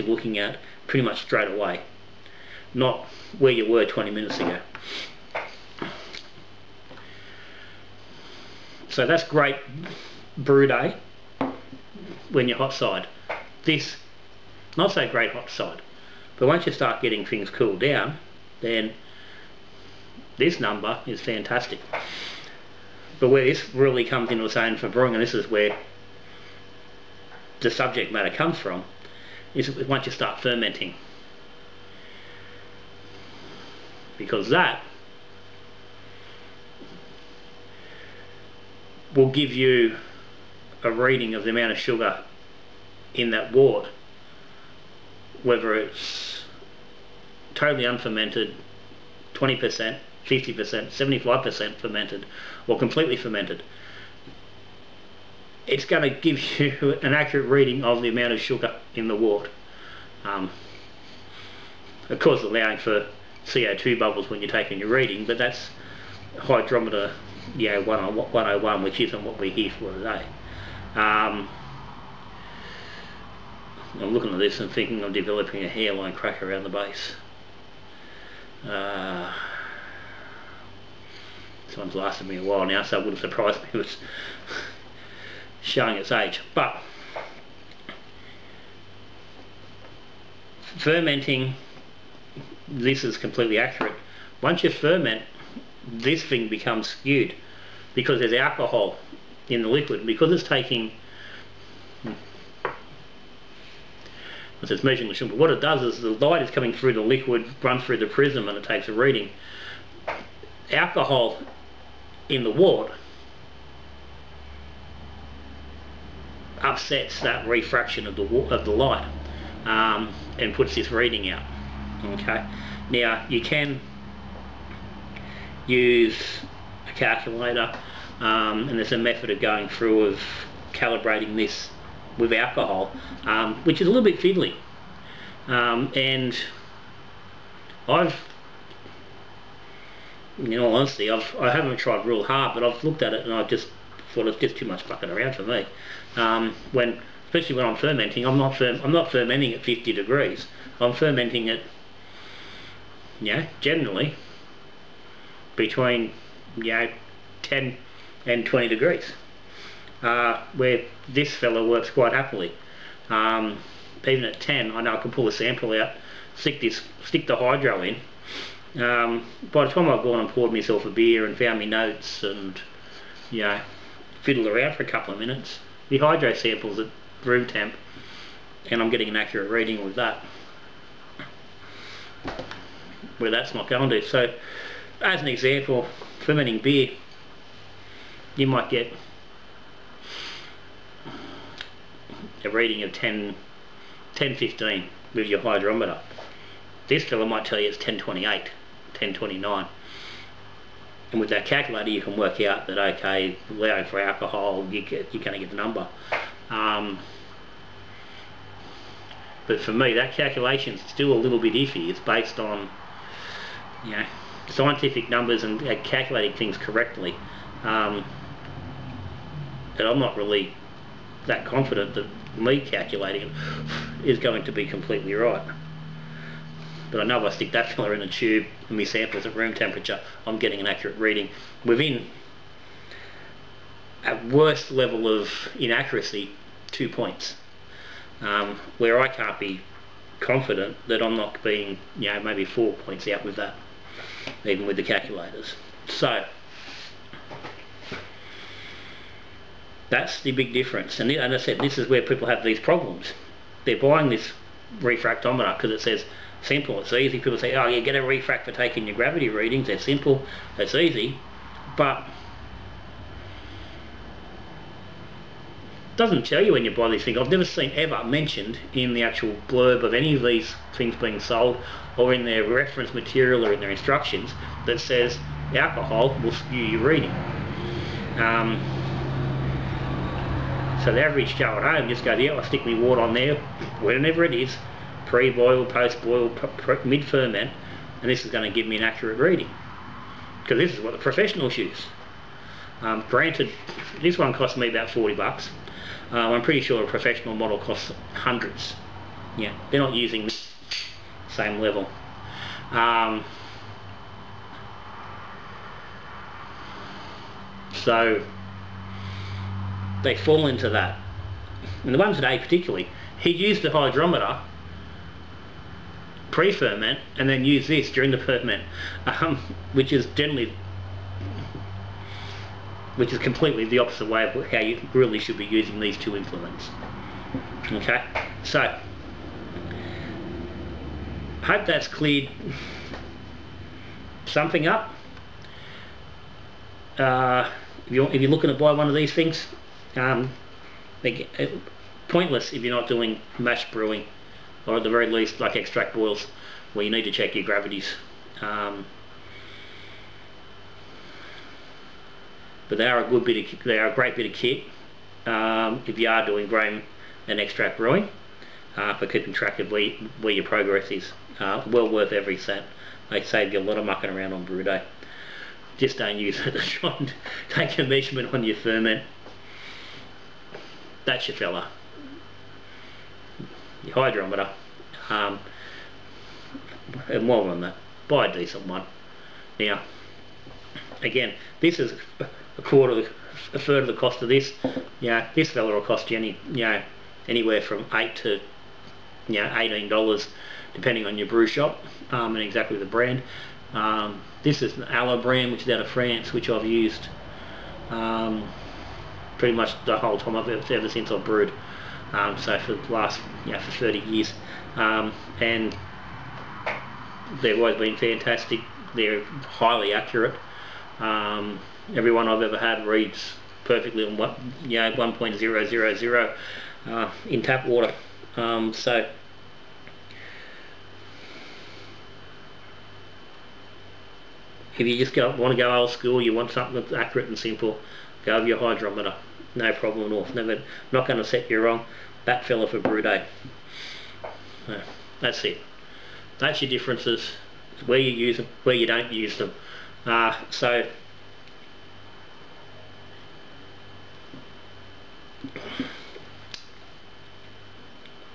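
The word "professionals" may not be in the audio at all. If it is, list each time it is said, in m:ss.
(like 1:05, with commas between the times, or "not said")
4:50, 4:56.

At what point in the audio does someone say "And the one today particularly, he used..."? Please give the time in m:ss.
5:11.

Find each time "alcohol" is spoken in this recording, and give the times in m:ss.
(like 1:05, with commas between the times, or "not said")
1:38, 1:50, 2:12, 3:23, 4:35.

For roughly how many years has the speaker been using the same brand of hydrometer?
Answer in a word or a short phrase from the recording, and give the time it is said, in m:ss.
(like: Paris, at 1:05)
30 years, at 6:43.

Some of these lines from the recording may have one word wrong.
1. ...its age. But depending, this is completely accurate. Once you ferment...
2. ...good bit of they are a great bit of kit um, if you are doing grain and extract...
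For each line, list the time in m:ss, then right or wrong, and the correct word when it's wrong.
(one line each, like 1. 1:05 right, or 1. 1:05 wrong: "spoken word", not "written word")
1. 1:25 wrong: "fermenting", not "depending"
2. 5:53 right.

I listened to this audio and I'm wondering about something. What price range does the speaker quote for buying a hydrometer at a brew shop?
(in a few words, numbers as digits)
8 to 18 dollars.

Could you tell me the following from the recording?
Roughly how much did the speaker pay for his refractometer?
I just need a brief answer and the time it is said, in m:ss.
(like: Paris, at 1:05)
About 40 bucks, at 4:54.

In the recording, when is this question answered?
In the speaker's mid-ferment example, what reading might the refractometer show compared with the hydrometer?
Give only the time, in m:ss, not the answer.
3:17.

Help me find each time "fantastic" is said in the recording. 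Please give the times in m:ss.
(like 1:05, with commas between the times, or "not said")
0:21, 6:47.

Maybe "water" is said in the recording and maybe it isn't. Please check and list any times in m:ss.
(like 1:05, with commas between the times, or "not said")
1:52, 6:57.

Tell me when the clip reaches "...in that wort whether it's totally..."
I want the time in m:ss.
0:43.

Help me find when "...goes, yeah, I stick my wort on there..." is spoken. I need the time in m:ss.
4:42.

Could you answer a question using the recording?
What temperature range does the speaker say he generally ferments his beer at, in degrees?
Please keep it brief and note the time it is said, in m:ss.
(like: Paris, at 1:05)
10 to 20 degrees, at 2:35.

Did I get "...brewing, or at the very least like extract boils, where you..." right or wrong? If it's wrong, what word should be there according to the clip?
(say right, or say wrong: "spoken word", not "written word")
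right.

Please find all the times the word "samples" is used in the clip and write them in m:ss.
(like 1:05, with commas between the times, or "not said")
2:45, 2:56, 3:48.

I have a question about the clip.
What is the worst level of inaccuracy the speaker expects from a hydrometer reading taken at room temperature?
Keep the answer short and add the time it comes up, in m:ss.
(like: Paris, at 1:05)
2 points, at 3:56.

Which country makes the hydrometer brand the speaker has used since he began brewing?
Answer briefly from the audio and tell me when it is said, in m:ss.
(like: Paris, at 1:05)
France, at 6:35.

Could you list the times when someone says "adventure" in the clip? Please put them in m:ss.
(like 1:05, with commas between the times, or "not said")
not said.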